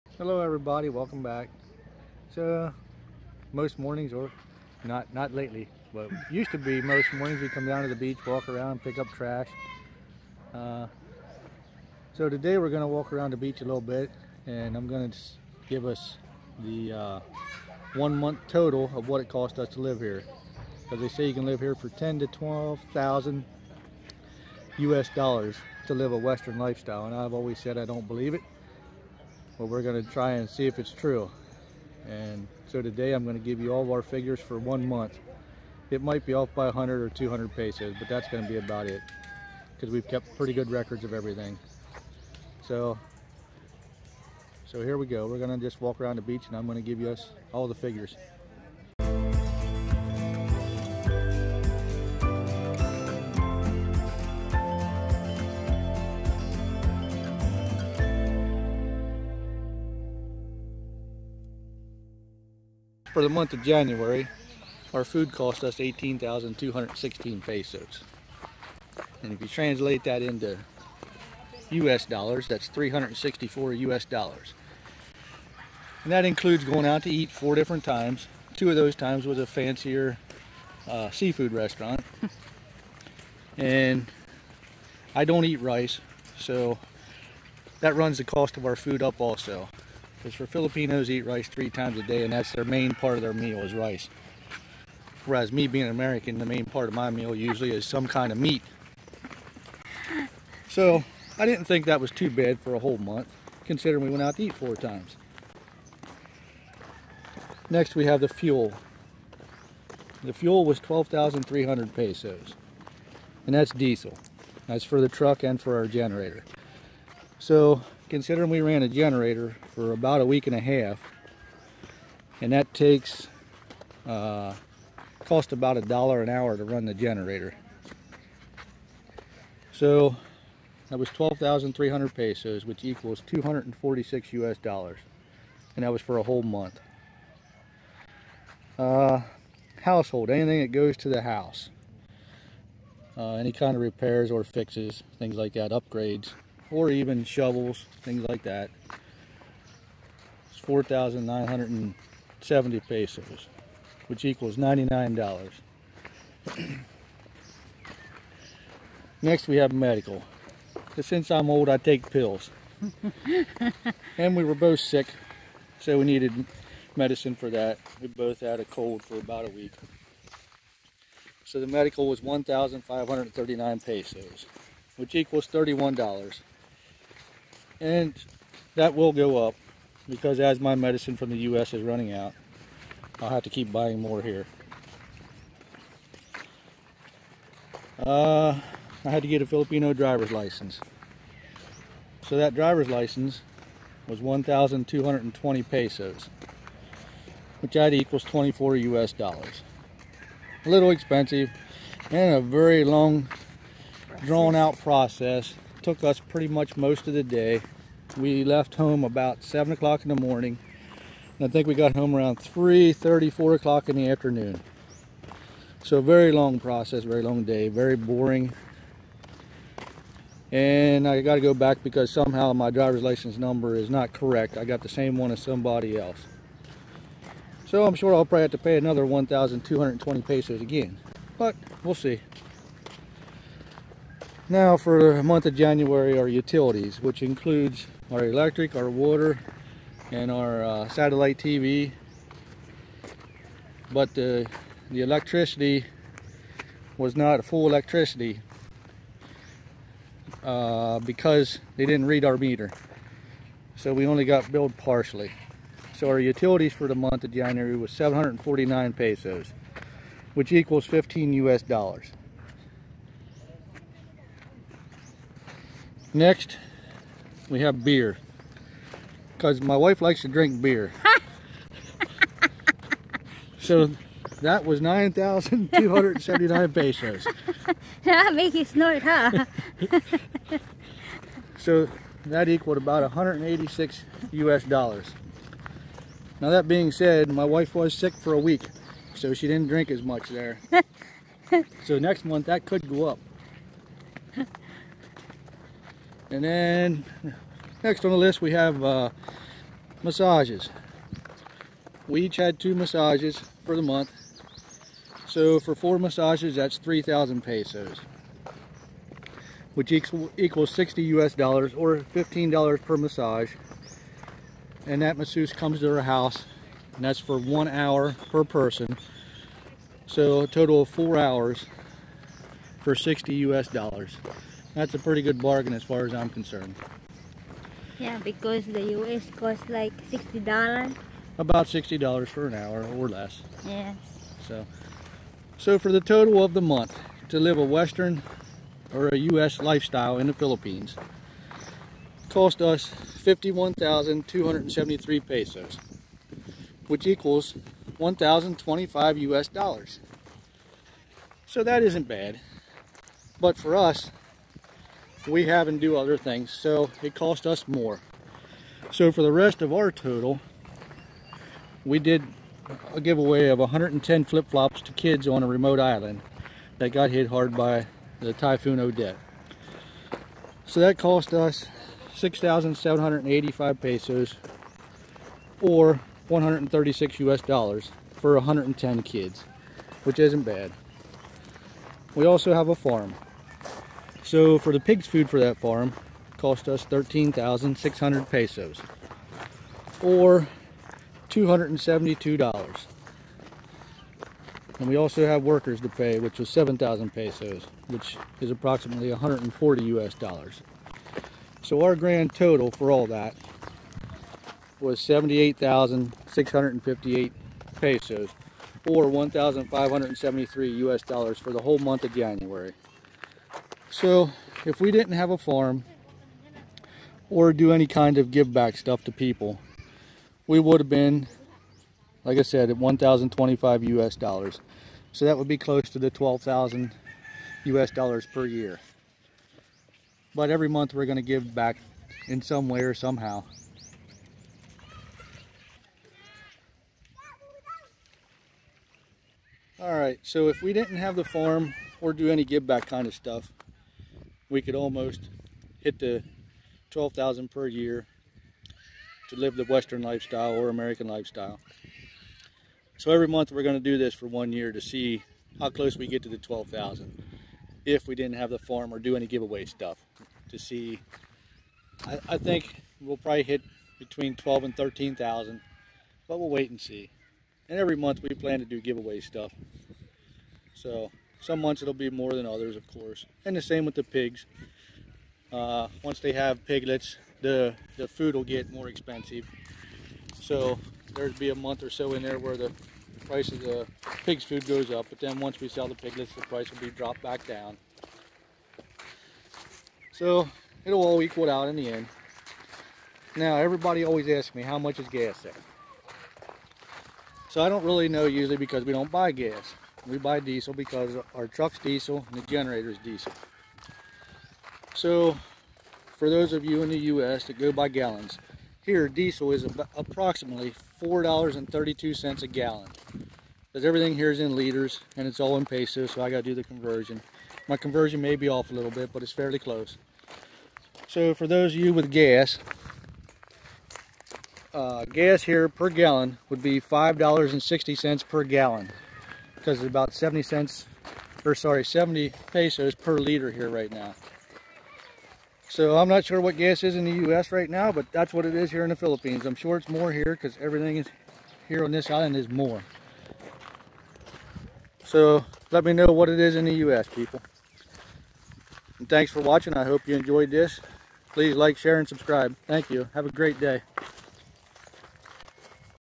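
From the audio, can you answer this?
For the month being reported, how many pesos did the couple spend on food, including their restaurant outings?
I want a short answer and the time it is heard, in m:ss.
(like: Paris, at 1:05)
18,216 pesos, at 1:05.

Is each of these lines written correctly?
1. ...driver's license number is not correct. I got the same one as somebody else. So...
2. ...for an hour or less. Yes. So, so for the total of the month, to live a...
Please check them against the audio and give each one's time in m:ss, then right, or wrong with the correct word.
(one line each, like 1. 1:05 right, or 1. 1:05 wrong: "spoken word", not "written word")
1. 3:42 right
2. 5:32 right.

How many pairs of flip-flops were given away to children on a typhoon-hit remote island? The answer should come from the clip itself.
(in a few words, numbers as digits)
110.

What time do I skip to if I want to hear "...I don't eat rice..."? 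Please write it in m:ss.
1:25.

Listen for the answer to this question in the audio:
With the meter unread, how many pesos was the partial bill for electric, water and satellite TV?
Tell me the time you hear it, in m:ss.
4:17.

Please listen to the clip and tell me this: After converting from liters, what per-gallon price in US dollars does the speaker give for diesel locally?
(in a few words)
$4.32.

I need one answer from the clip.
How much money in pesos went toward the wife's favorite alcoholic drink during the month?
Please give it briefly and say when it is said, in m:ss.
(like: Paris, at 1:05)
9,279 pesos, at 4:34.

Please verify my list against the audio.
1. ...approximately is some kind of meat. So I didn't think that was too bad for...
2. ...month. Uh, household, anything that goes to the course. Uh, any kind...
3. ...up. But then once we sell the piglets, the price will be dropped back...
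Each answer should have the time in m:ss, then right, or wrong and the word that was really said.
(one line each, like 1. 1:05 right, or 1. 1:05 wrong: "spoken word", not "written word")
1. 1:37 wrong: "usually", not "approximately"
2. 2:16 wrong: "house", not "course"
3. 8:04 right.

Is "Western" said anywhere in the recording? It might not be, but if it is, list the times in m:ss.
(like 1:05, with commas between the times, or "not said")
0:26, 5:37, 7:29.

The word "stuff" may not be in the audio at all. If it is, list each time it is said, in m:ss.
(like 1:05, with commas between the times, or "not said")
6:58, 7:23, 7:39, 7:49.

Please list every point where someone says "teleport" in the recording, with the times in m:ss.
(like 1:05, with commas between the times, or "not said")
not said.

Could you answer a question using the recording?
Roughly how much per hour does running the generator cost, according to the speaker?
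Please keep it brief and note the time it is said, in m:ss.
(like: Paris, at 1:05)
about a dollar, at 2:05.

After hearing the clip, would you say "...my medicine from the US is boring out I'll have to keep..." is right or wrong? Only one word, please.
wrong.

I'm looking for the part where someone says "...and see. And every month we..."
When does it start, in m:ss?
7:46.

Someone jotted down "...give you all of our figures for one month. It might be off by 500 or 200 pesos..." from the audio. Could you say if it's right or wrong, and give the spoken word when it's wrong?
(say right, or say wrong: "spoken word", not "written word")
wrong: "100", not "500".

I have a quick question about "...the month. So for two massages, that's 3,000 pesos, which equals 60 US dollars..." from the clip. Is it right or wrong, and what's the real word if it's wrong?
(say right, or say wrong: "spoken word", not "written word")
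wrong: "four", not "two".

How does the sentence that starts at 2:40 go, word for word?
Since I'm old, I take pills.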